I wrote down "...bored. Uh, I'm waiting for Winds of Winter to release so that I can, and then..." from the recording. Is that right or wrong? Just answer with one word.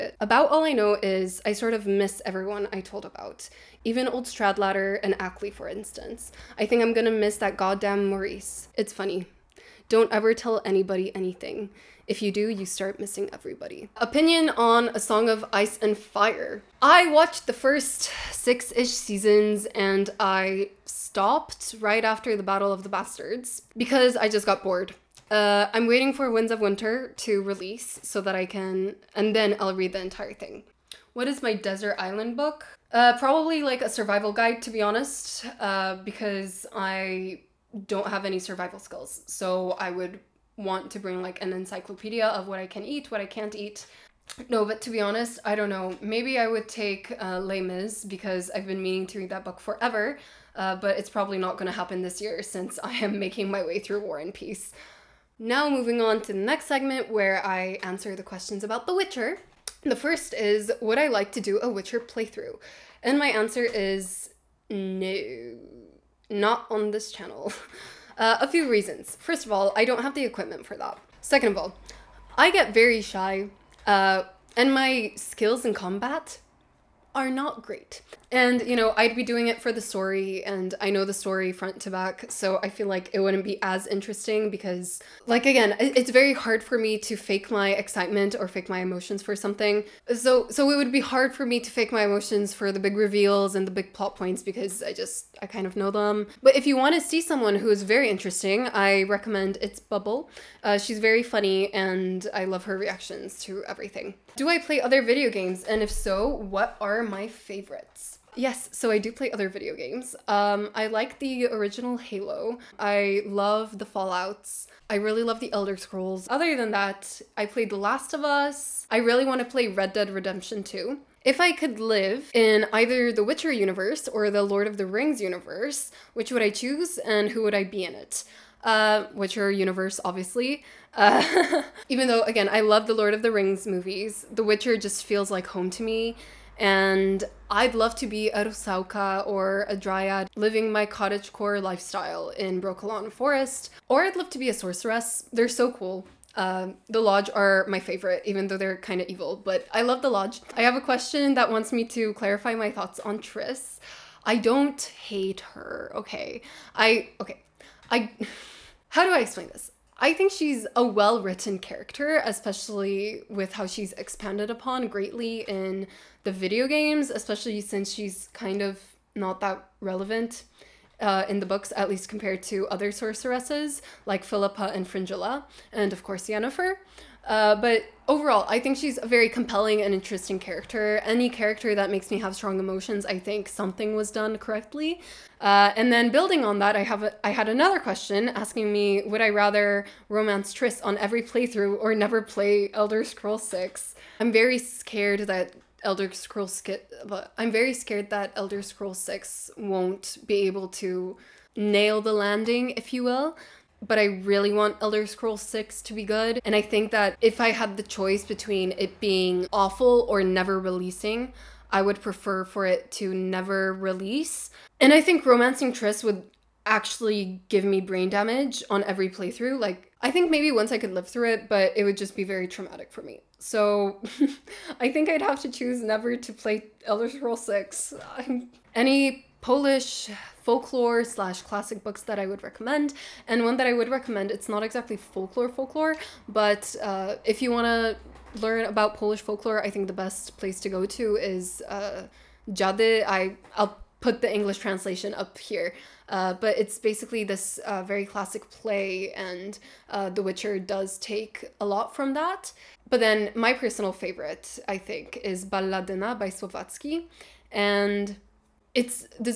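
right.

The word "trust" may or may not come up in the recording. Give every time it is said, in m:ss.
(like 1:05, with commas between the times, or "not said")
not said.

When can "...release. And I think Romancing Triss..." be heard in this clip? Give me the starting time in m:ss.
3:33.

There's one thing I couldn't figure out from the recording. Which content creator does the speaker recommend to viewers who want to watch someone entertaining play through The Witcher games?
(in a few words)
It's Bubble.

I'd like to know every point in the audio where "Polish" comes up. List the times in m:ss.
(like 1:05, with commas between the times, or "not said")
3:49, 3:58.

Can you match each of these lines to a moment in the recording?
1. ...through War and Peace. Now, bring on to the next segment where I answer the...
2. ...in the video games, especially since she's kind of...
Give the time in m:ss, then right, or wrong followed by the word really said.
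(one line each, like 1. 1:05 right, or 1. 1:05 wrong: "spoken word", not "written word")
1. 0:53 wrong: "moving", not "bring"
2. 2:45 right.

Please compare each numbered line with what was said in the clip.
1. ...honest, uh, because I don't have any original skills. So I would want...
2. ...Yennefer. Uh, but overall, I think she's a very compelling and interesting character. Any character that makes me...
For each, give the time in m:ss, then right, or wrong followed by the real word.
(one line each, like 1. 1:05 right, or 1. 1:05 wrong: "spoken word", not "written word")
1. 0:34 wrong: "survival", not "original"
2. 2:56 right.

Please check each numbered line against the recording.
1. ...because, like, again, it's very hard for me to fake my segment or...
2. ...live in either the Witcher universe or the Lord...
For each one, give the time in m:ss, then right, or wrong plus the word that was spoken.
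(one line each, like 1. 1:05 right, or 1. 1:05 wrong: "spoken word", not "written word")
1. 1:24 wrong: "excitement", not "segment"
2. 2:01 right.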